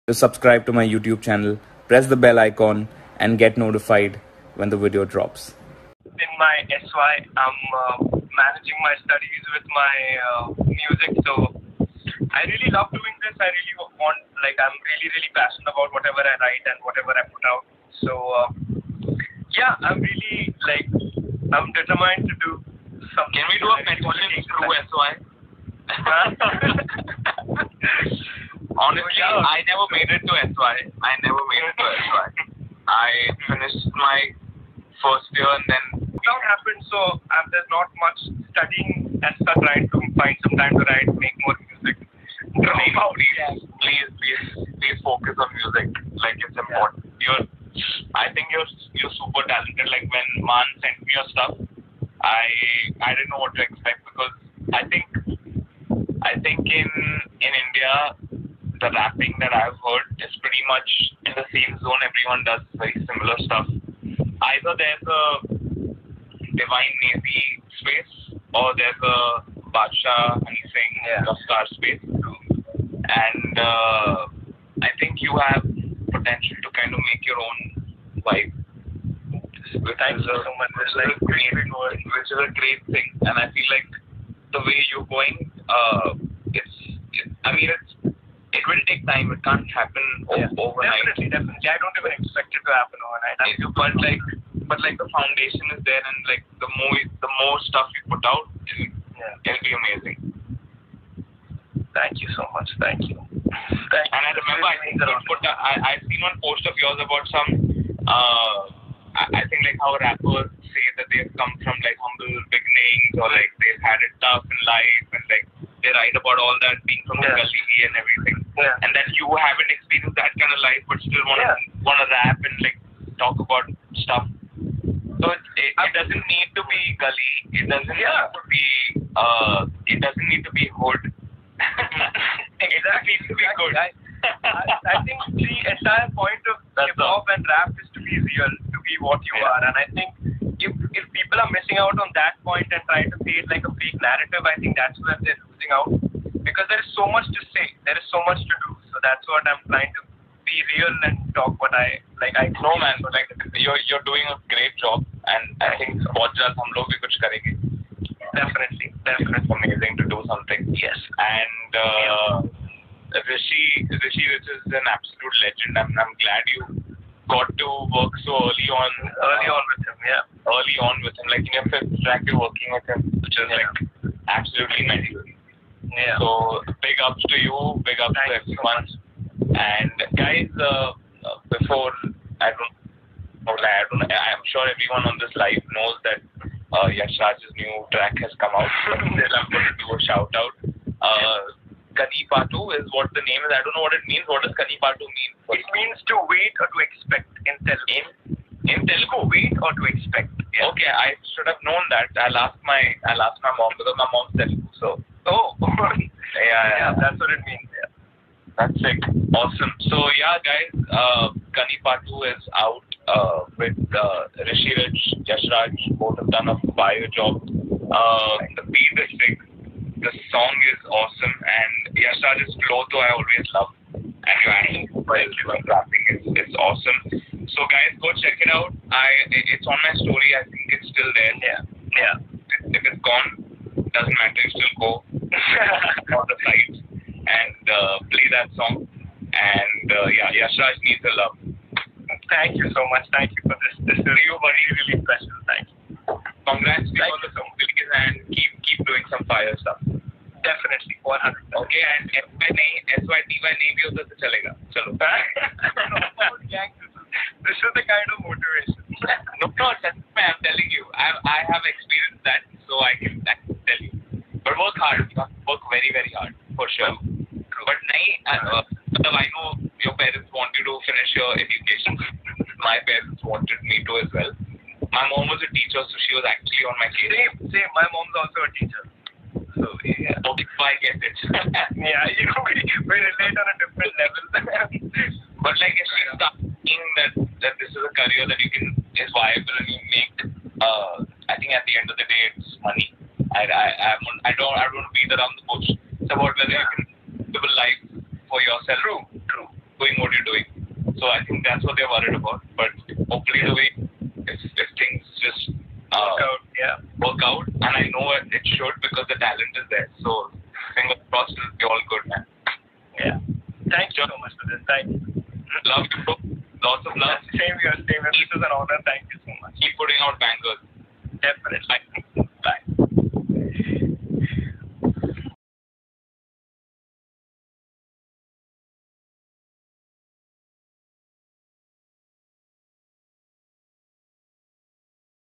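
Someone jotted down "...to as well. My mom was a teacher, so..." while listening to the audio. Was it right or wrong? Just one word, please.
right.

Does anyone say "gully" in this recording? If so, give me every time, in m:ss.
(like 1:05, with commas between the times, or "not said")
1:57, 2:06.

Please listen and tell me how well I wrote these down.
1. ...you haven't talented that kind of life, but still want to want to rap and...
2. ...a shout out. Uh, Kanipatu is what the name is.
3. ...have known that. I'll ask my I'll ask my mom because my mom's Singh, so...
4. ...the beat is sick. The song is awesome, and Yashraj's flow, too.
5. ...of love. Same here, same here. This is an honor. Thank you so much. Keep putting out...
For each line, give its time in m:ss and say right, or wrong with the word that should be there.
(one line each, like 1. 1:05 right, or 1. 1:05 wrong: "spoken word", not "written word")
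1. 1:59 wrong: "experienced", not "talented"
2. 3:09 right
3. 3:21 wrong: "Telugu", not "Singh"
4. 3:38 right
5. 5:16 right.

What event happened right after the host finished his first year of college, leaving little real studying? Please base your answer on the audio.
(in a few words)
Lockdown.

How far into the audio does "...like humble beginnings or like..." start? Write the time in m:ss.
1:51.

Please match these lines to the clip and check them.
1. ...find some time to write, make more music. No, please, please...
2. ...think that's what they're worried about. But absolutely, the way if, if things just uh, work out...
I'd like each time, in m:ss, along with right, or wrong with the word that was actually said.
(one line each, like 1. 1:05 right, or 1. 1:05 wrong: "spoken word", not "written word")
1. 0:40 right
2. 5:01 wrong: "hopefully", not "absolutely".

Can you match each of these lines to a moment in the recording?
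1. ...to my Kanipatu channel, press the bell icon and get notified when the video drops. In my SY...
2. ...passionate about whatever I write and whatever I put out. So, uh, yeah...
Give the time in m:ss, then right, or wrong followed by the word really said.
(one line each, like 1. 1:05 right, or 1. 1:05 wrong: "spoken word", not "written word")
1. 0:00 wrong: "YouTube", not "Kanipatu"
2. 0:15 right.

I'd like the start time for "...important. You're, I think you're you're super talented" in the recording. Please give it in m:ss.
0:46.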